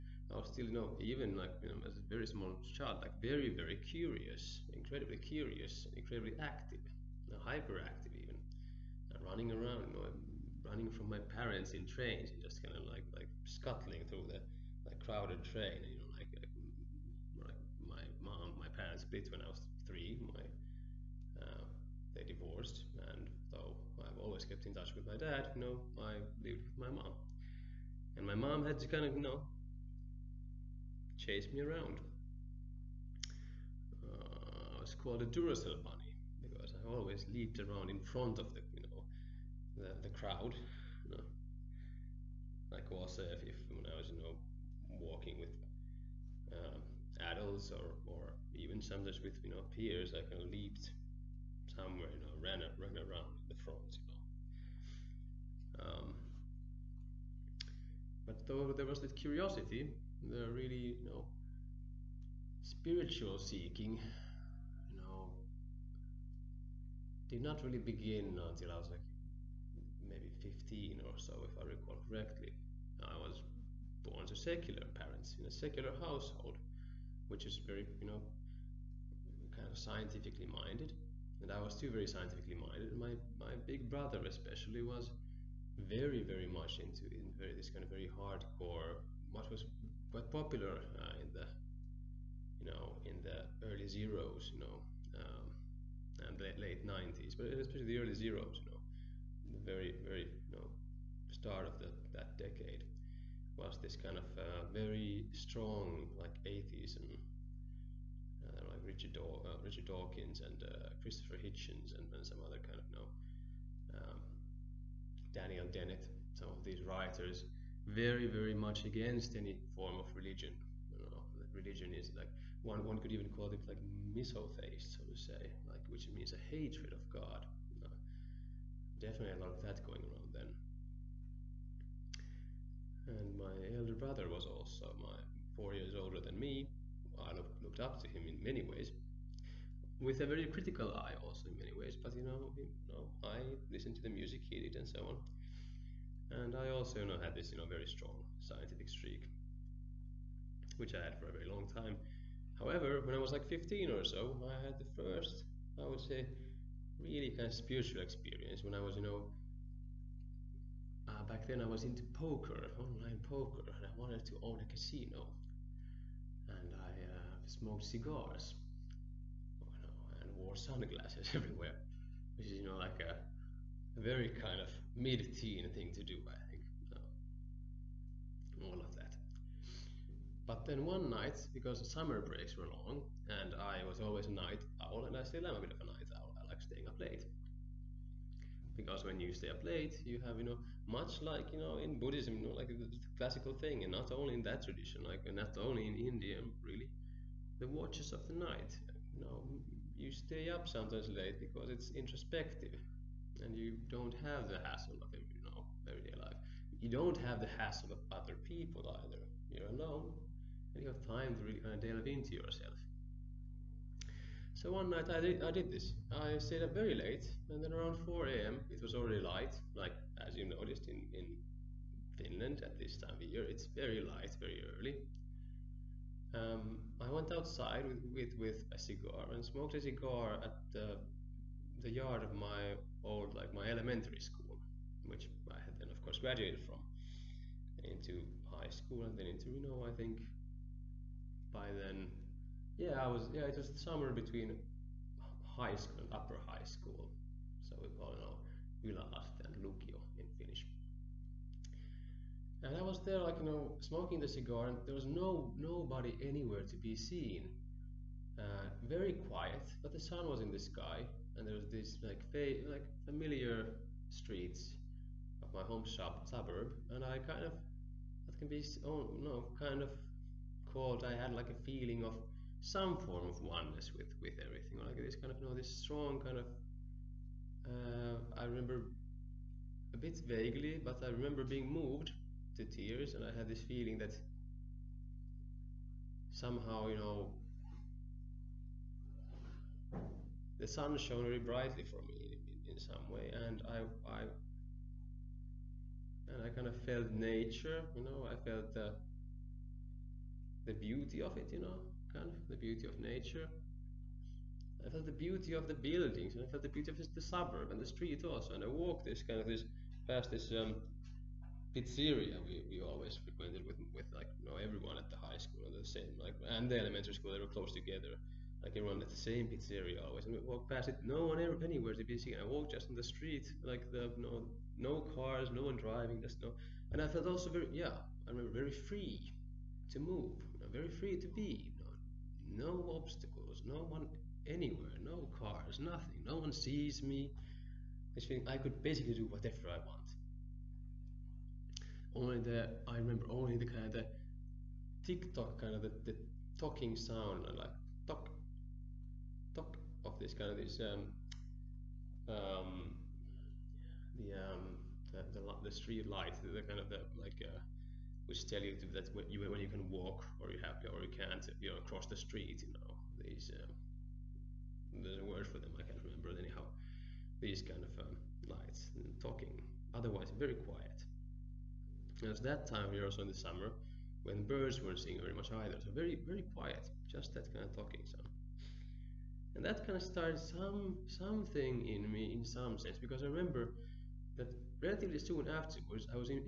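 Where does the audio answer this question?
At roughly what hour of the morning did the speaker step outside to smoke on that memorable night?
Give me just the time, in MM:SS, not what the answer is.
03:38.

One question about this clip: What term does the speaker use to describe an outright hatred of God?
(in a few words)
misotheist.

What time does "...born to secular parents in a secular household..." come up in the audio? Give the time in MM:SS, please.
01:14.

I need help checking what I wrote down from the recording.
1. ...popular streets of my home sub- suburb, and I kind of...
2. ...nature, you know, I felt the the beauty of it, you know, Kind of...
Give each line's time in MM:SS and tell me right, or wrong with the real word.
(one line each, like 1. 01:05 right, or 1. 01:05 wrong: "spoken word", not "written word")
1. 04:23 wrong: "familiar", not "popular"
2. 04:57 right.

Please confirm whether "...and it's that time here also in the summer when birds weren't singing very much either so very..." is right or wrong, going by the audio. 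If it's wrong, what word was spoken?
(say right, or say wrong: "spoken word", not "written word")
right.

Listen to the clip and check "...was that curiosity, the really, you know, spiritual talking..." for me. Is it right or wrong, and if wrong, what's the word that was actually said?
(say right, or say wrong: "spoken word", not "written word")
wrong: "seeking", not "talking".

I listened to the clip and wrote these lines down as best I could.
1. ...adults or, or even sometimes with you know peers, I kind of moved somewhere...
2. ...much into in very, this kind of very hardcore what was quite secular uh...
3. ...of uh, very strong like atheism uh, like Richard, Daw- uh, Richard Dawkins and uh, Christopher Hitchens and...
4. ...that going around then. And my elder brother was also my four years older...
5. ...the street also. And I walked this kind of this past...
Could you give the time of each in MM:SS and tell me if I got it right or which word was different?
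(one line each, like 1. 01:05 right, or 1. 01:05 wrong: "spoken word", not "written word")
1. 00:47 wrong: "leaped", not "moved"
2. 01:26 wrong: "popular", not "secular"
3. 01:44 right
4. 02:09 right
5. 05:07 right.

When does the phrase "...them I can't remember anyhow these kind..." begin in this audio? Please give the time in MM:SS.
06:05.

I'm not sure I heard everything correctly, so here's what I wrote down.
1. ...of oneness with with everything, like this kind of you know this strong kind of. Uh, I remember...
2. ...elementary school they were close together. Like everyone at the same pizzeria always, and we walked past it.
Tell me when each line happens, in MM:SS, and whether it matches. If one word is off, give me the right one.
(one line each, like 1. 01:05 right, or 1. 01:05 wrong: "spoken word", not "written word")
1. 04:33 right
2. 05:16 right.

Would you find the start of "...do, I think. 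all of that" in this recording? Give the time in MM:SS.
02:56.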